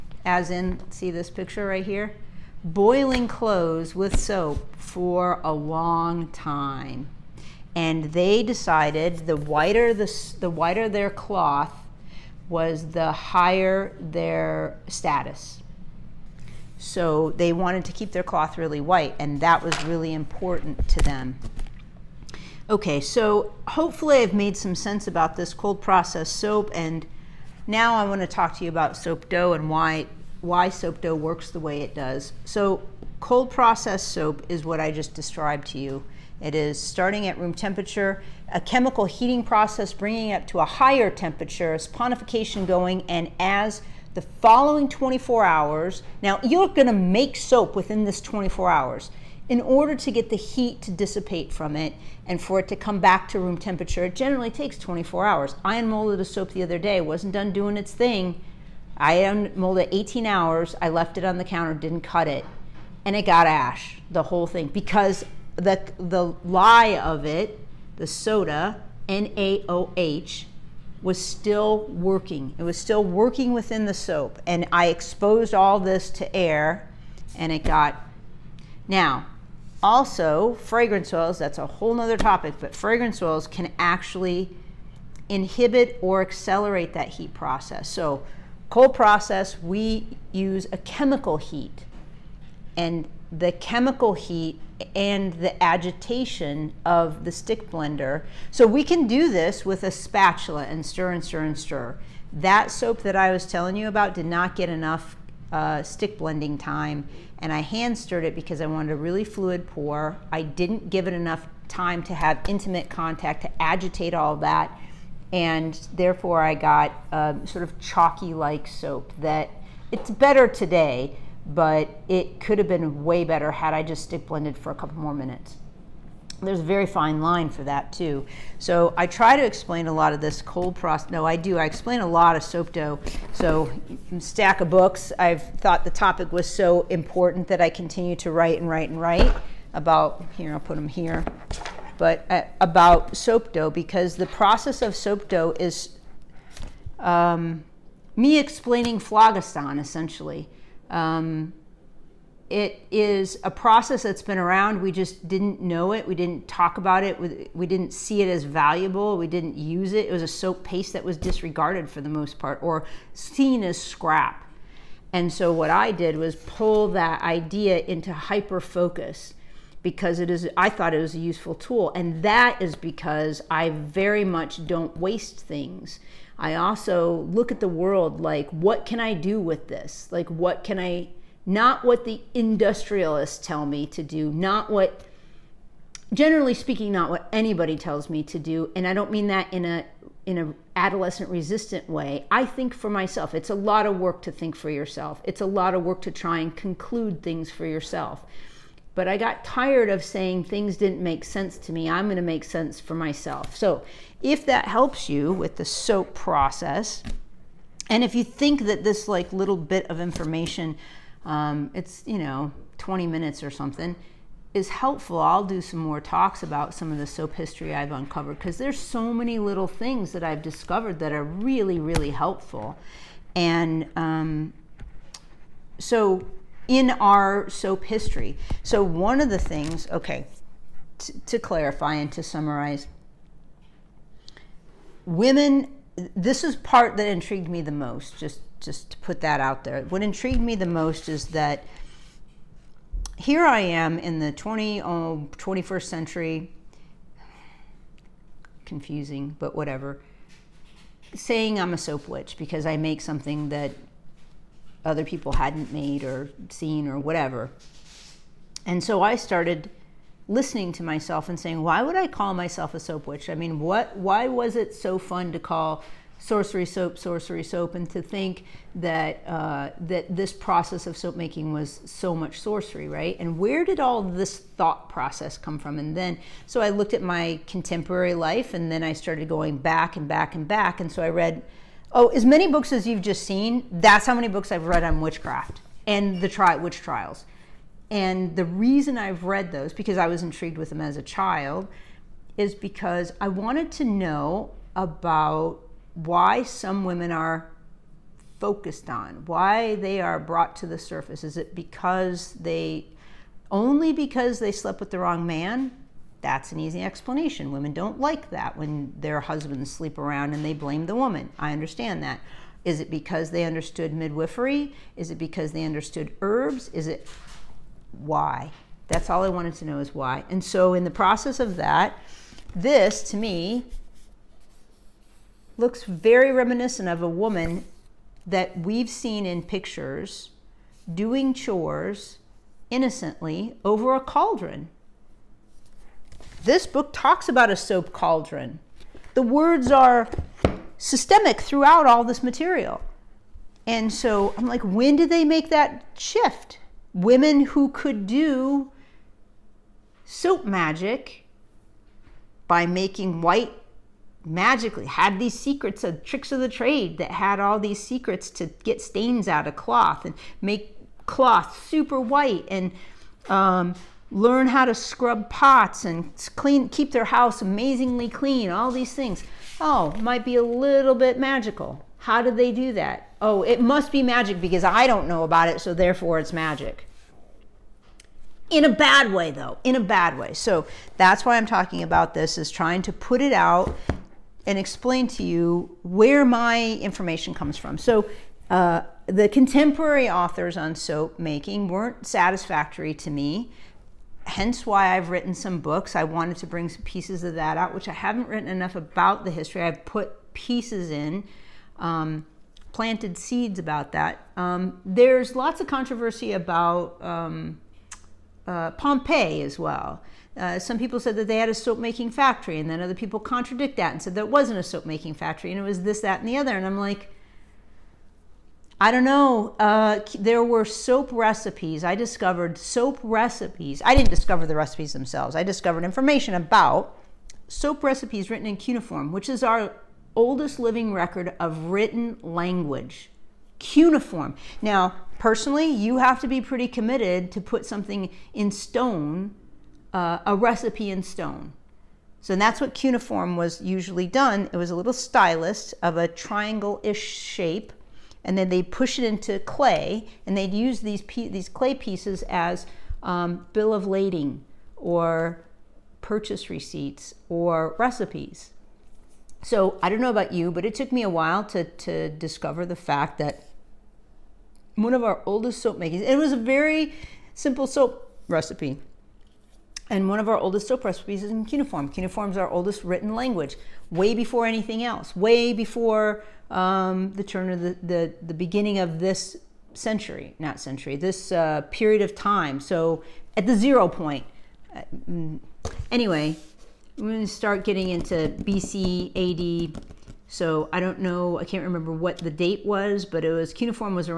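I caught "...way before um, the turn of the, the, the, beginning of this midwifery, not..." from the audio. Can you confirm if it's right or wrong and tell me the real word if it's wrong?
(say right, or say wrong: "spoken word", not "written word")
wrong: "century", not "midwifery".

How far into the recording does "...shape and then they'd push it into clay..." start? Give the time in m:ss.
7:27.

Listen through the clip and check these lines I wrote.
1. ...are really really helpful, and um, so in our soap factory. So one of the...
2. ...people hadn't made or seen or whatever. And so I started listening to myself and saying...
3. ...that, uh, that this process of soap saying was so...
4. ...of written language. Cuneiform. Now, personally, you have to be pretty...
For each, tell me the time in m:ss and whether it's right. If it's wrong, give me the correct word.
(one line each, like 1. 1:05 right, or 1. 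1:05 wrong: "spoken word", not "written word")
1. 3:41 wrong: "history", not "factory"
2. 4:15 right
3. 4:28 wrong: "making", not "saying"
4. 7:11 right.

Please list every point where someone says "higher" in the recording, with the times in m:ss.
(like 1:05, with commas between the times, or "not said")
0:13, 0:40.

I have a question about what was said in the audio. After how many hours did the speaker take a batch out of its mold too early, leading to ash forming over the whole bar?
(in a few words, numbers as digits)
18.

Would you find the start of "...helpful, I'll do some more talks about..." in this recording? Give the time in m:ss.
3:34.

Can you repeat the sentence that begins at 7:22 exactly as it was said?
So that's what cuneiform was usually done.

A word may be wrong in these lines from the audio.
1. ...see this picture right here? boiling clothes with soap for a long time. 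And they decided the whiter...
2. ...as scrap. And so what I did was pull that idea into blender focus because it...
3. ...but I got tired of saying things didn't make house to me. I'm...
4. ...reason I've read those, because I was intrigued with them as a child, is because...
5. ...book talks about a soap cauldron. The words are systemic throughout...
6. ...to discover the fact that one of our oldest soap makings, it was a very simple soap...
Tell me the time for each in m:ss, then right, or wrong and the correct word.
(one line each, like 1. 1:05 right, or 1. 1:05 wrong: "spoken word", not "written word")
1. 0:00 right
2. 2:43 wrong: "hyper", not "blender"
3. 3:18 wrong: "sense", not "house"
4. 4:48 right
5. 5:36 right
6. 7:41 right.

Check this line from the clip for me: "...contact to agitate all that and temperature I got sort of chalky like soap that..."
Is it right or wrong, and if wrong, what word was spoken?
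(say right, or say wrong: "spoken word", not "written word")
wrong: "therefore", not "temperature".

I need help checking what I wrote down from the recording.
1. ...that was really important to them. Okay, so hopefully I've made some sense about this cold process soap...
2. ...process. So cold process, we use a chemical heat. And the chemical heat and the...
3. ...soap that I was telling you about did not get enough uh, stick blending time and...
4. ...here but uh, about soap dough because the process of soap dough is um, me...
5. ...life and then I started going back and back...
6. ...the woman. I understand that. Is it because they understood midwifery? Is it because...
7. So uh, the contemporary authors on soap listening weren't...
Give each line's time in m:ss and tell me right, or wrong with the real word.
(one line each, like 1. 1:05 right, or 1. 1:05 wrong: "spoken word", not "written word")
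1. 0:19 right
2. 1:27 right
3. 1:42 right
4. 2:20 right
5. 4:38 right
6. 5:10 right
7. 6:27 wrong: "making", not "listening".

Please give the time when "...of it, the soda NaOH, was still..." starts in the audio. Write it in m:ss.
1:06.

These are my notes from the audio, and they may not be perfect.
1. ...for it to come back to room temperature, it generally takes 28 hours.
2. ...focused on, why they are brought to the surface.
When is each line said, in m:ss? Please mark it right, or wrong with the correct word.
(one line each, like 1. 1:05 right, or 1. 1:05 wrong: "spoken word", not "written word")
1. 0:52 wrong: "24", not "28"
2. 4:58 right.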